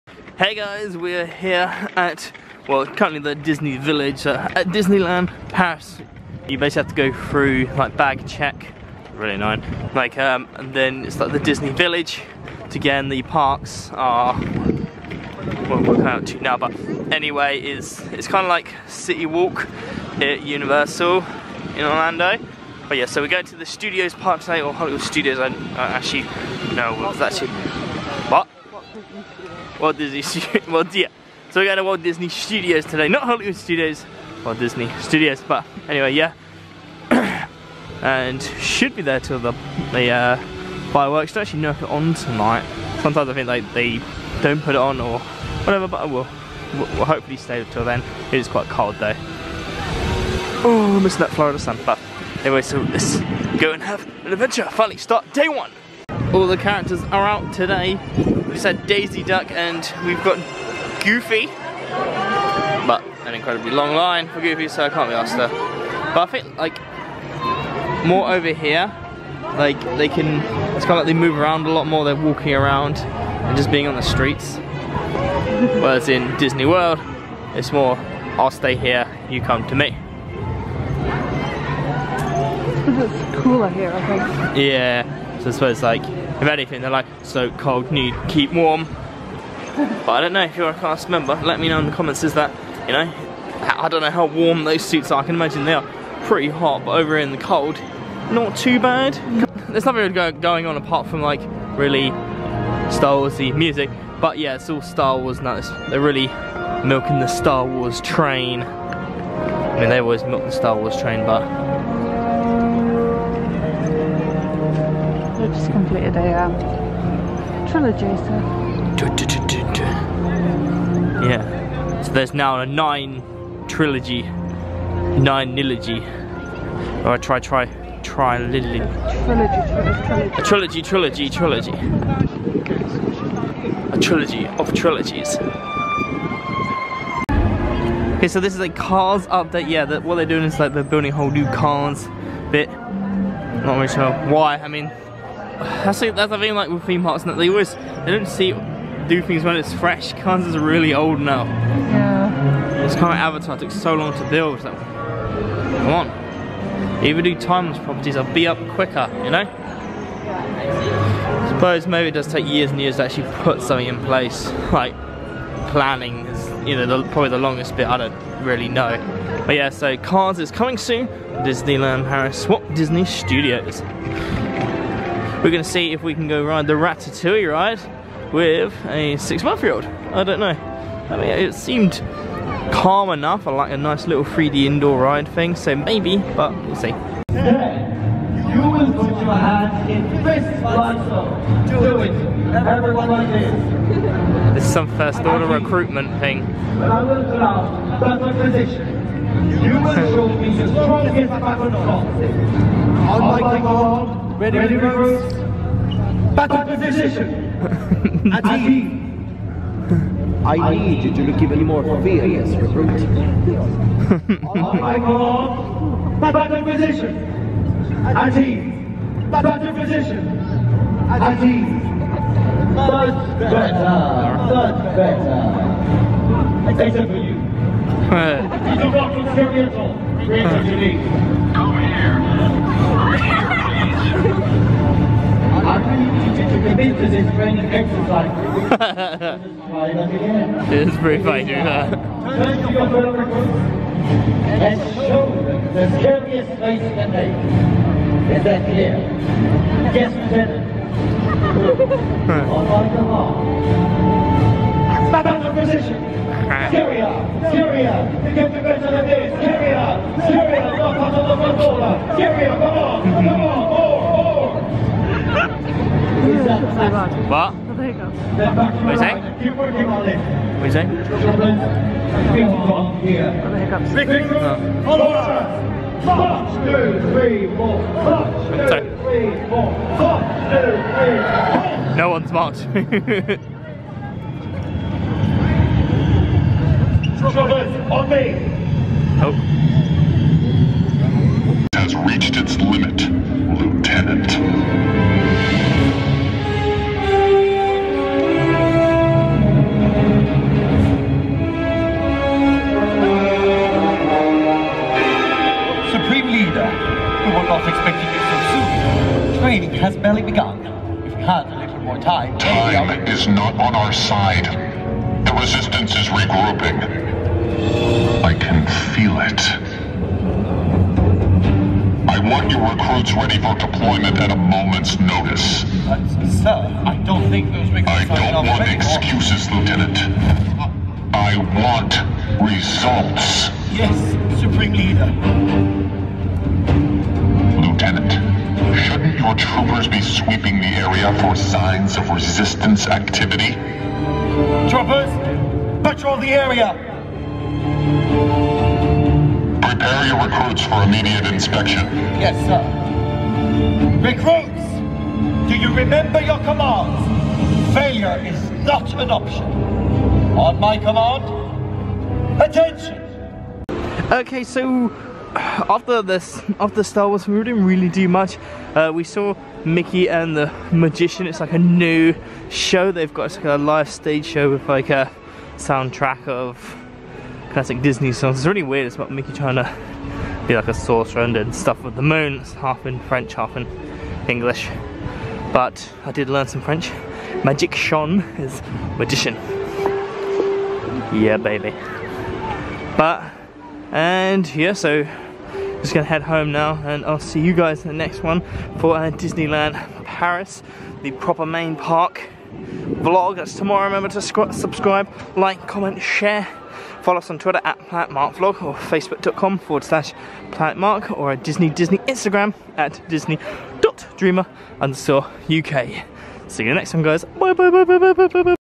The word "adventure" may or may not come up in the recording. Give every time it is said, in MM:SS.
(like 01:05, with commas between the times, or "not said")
00:54.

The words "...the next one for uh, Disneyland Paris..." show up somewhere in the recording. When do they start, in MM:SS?
06:37.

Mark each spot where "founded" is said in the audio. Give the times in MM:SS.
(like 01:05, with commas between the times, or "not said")
not said.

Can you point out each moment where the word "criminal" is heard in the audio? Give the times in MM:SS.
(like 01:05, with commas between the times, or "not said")
not said.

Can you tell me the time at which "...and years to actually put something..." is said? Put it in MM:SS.
02:42.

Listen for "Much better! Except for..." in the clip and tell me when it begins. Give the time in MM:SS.
03:44.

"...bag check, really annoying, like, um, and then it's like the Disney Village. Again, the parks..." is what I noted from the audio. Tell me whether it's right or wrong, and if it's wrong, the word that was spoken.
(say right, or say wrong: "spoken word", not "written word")
right.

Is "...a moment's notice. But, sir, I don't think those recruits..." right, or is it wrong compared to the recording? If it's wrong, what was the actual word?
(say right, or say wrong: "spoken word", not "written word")
right.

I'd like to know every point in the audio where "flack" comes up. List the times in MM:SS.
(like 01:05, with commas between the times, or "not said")
not said.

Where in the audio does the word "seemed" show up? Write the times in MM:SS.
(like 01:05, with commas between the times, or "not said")
03:01.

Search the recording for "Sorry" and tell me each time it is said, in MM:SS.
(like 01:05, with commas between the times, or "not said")
04:38.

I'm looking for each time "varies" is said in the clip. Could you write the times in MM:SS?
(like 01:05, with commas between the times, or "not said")
not said.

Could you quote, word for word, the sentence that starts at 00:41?
Don't actually know if it's on tonight.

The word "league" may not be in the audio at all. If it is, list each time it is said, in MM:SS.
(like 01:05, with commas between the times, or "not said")
not said.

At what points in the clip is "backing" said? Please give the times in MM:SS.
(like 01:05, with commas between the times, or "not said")
not said.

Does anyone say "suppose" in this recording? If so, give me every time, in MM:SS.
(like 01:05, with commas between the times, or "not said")
01:25, 02:41.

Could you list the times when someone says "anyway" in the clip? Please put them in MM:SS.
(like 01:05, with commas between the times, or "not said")
00:17, 00:35, 00:52.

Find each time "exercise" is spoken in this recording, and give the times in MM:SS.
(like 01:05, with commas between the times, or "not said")
03:57.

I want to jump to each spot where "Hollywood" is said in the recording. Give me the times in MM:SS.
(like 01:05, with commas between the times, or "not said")
00:24, 00:33.